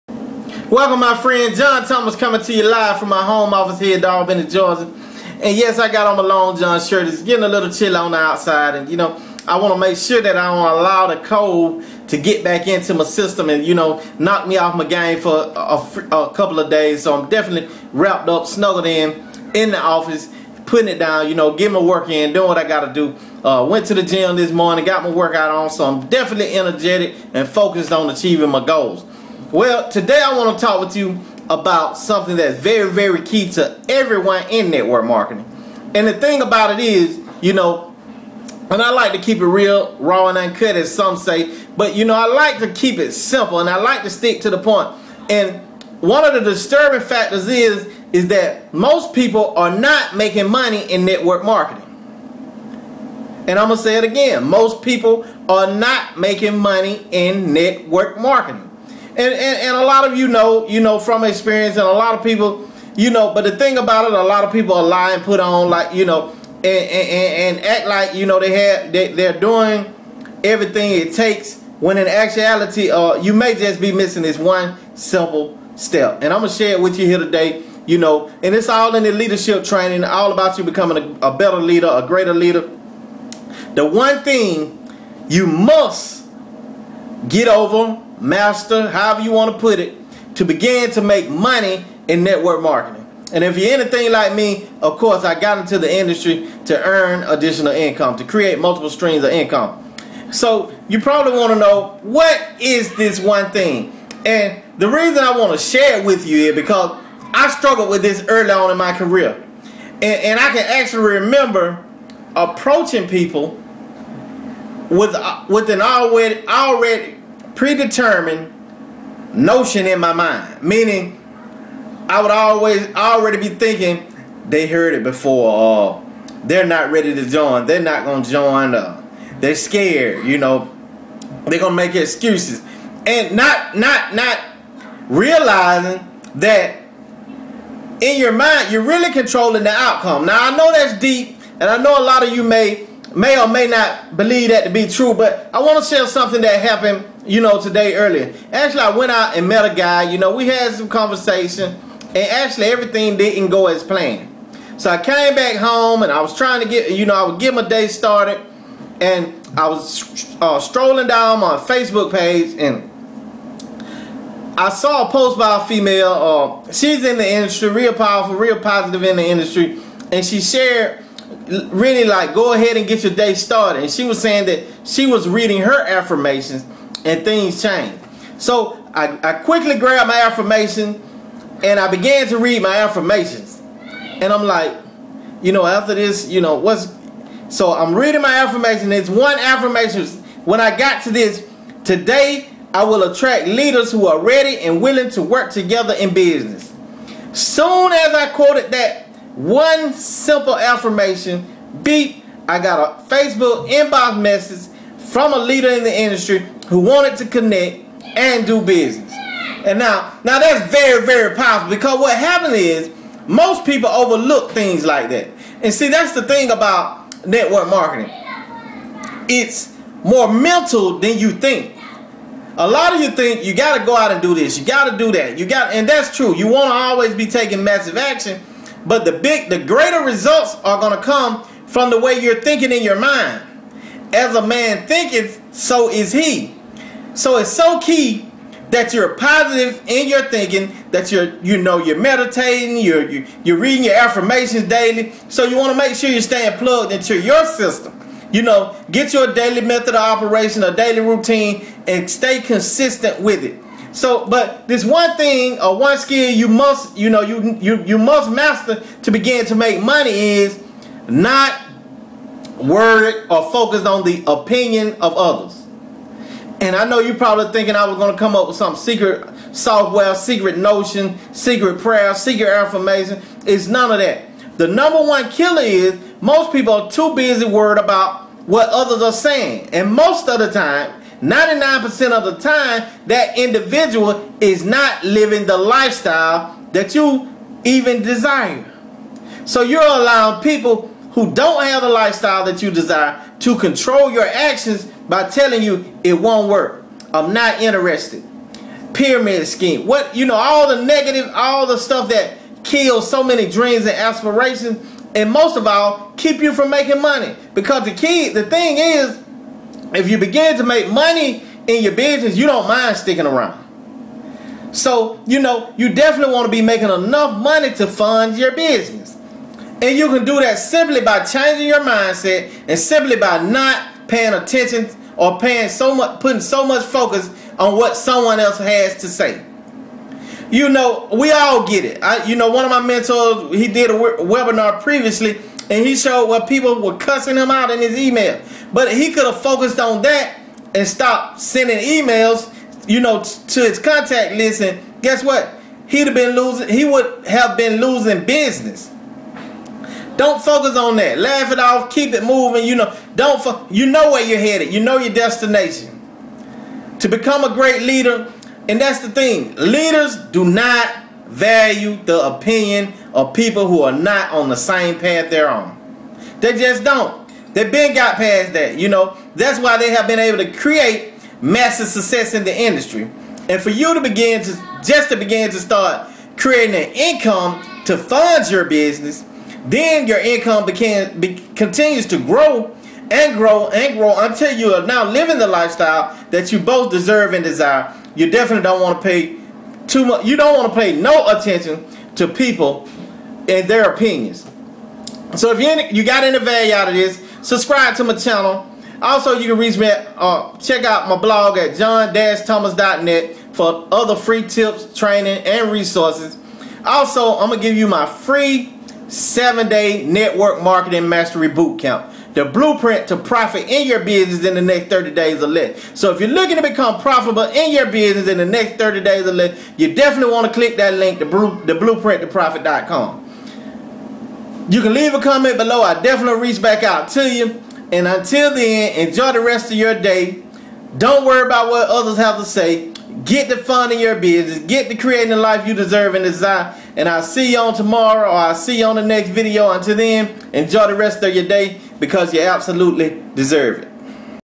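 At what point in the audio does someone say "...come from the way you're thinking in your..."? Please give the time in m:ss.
3:51.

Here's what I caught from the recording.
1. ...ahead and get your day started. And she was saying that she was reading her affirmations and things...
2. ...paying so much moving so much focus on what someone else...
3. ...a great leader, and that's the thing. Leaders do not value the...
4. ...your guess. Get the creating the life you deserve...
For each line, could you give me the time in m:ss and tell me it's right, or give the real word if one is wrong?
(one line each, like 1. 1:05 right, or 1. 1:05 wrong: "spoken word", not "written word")
1. 2:52 right
2. 5:25 wrong: "putting", not "moving"
3. 5:57 right
4. 7:13 wrong: "business", not "guess".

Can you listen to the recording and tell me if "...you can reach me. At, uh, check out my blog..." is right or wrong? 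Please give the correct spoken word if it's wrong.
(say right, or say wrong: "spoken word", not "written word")
right.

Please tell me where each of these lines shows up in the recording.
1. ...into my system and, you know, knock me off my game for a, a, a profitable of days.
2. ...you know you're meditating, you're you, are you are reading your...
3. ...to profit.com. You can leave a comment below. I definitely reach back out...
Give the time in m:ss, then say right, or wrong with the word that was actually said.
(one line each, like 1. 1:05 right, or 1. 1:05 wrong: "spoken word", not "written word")
1. 0:12 wrong: "couple", not "profitable"
2. 4:01 right
3. 7:02 right.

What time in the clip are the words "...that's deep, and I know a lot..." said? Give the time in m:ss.
2:20.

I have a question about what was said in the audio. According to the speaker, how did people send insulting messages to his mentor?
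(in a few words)
email.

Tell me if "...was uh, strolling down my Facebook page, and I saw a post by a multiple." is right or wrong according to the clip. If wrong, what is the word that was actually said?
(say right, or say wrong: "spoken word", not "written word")
wrong: "female", not "multiple".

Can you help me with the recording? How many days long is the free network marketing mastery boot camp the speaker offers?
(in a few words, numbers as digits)
7.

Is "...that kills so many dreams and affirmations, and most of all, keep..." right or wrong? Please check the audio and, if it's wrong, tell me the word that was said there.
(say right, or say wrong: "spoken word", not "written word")
wrong: "aspirations", not "affirmations".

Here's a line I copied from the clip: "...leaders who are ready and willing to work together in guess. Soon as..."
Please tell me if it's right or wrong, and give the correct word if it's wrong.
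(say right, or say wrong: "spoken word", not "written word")
wrong: "business", not "guess".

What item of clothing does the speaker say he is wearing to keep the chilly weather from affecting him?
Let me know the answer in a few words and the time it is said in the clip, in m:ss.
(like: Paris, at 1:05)
Long John shirt, at 0:06.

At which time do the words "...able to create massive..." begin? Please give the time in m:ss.
6:10.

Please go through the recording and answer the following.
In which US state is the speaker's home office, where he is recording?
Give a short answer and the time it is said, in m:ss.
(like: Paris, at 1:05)
Georgia, at 0:04.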